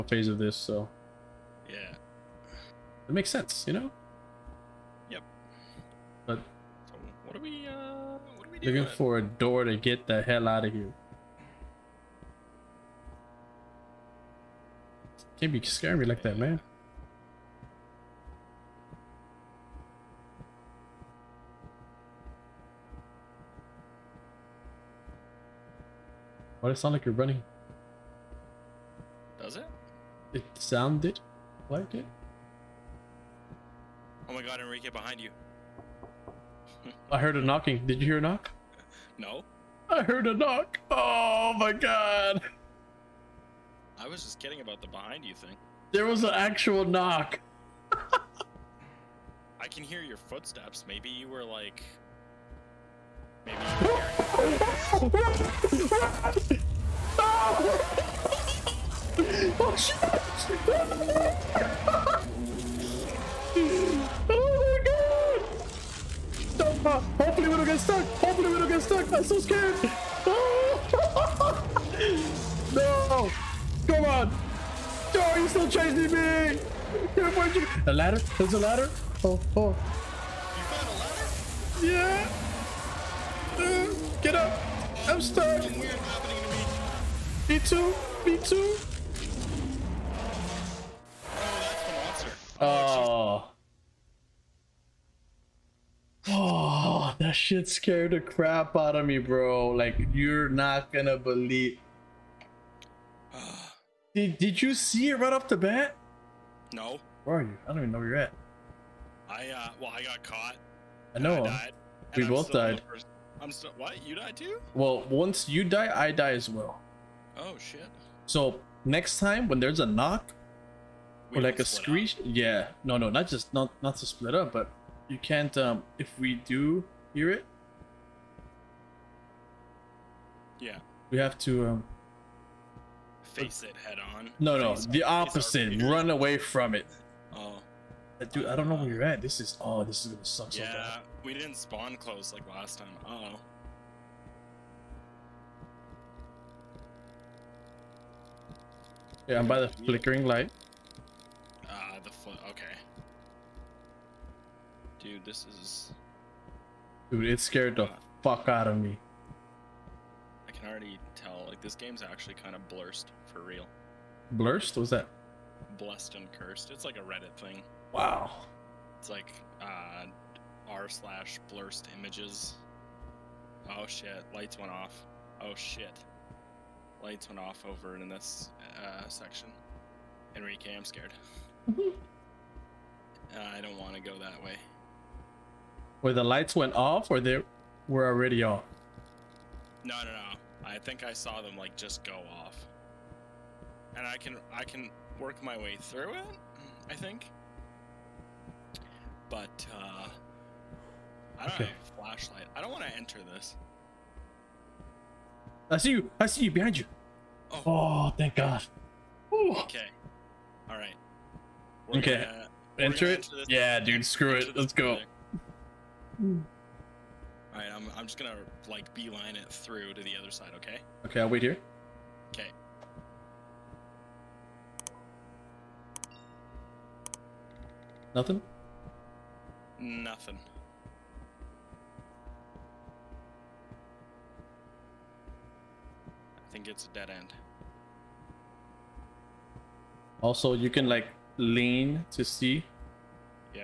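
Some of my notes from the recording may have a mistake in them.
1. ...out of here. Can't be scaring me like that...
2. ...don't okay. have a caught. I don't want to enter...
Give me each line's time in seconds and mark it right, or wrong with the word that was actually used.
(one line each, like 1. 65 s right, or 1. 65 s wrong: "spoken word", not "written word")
1. 10 s right
2. 201 s wrong: "flashlight", not "caught".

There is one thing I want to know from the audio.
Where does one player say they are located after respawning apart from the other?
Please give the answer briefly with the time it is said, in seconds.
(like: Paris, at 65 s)
By the flickering light, at 149 s.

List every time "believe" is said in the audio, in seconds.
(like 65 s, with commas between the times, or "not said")
101 s.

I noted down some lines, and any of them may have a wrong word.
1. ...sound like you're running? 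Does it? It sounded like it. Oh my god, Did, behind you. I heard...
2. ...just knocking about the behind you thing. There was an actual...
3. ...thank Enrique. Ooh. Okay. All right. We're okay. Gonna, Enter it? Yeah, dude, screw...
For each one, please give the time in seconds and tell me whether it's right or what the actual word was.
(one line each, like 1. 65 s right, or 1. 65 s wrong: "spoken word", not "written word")
1. 26 s wrong: "Enrique", not "Did"
2. 44 s wrong: "kidding", not "knocking"
3. 208 s wrong: "God", not "Enrique".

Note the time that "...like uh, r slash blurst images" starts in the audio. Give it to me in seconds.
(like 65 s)
169 s.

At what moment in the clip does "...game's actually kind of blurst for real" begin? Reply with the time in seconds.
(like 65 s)
161 s.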